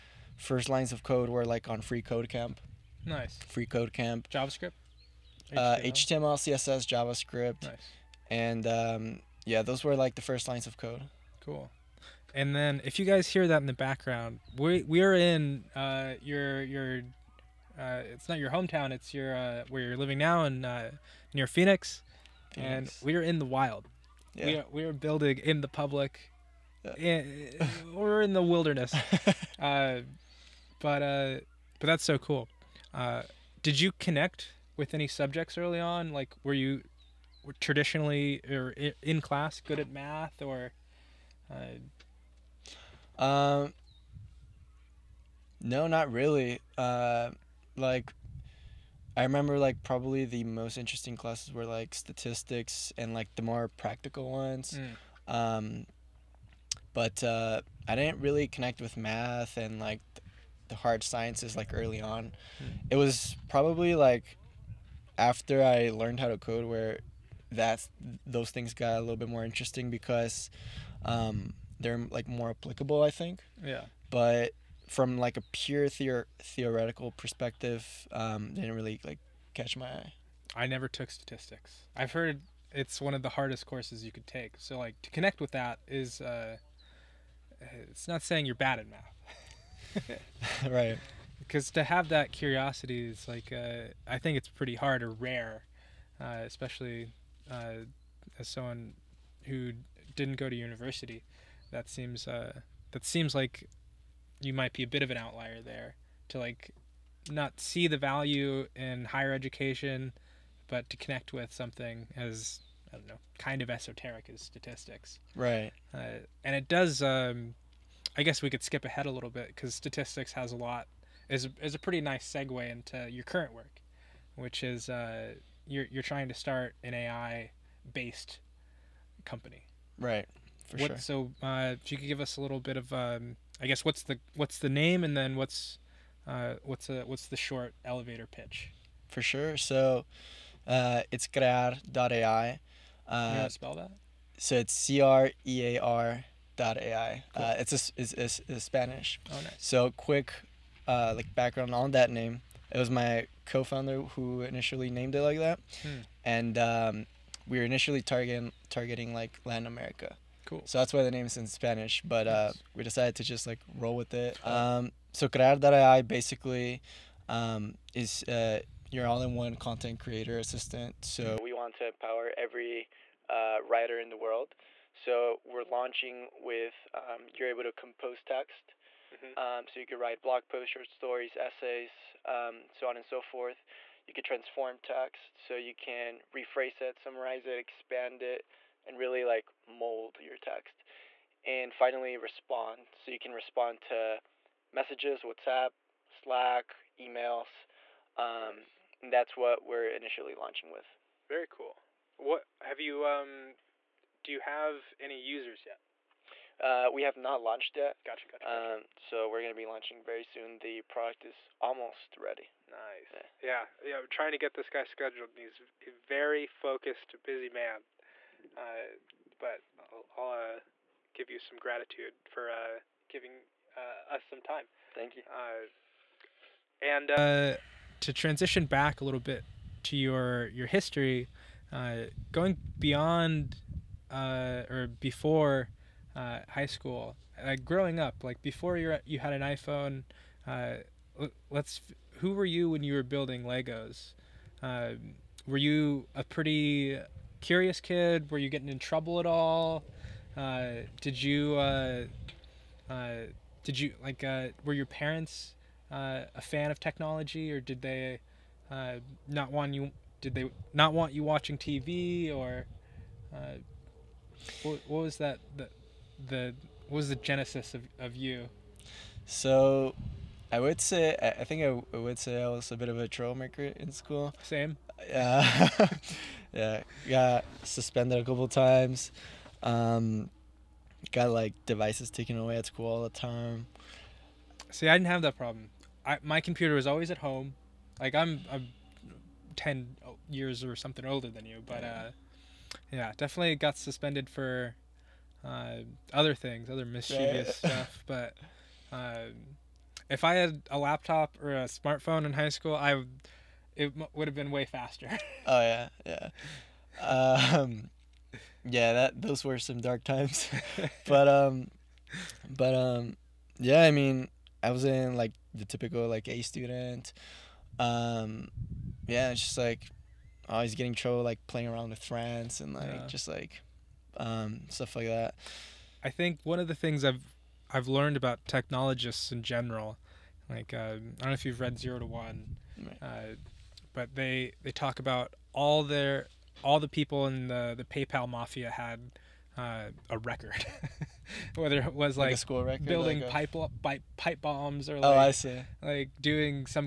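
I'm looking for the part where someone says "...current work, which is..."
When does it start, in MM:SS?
02:03.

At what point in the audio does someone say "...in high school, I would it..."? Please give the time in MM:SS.
05:02.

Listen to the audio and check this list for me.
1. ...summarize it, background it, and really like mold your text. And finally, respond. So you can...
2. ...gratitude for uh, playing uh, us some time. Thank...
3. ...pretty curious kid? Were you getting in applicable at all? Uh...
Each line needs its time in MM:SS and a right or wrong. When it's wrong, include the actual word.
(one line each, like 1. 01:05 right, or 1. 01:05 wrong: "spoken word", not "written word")
1. 03:06 wrong: "expand", not "background"
2. 03:41 wrong: "giving", not "playing"
3. 04:06 wrong: "trouble", not "applicable".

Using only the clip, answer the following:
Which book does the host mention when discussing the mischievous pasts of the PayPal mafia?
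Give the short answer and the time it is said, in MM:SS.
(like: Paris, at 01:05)
Zero to One, at 05:31.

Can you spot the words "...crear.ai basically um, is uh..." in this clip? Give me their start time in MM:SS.
02:45.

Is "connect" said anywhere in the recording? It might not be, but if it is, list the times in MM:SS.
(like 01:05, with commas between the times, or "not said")
00:33, 00:58, 01:25, 01:50.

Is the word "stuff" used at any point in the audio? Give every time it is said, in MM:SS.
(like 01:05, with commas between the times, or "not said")
04:57, 05:24.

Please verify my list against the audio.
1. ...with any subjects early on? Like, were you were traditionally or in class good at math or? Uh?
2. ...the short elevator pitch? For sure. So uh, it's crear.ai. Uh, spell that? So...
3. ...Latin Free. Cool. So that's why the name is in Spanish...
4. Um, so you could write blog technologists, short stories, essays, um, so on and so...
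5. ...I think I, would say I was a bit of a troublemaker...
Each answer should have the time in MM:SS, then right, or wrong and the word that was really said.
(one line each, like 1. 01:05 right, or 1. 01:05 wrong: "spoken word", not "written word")
1. 00:34 right
2. 02:17 right
3. 02:39 wrong: "America", not "Free"
4. 02:59 wrong: "posts", not "technologists"
5. 04:31 right.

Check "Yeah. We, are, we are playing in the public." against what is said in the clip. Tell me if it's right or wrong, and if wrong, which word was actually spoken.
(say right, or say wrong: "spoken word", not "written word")
wrong: "building", not "playing".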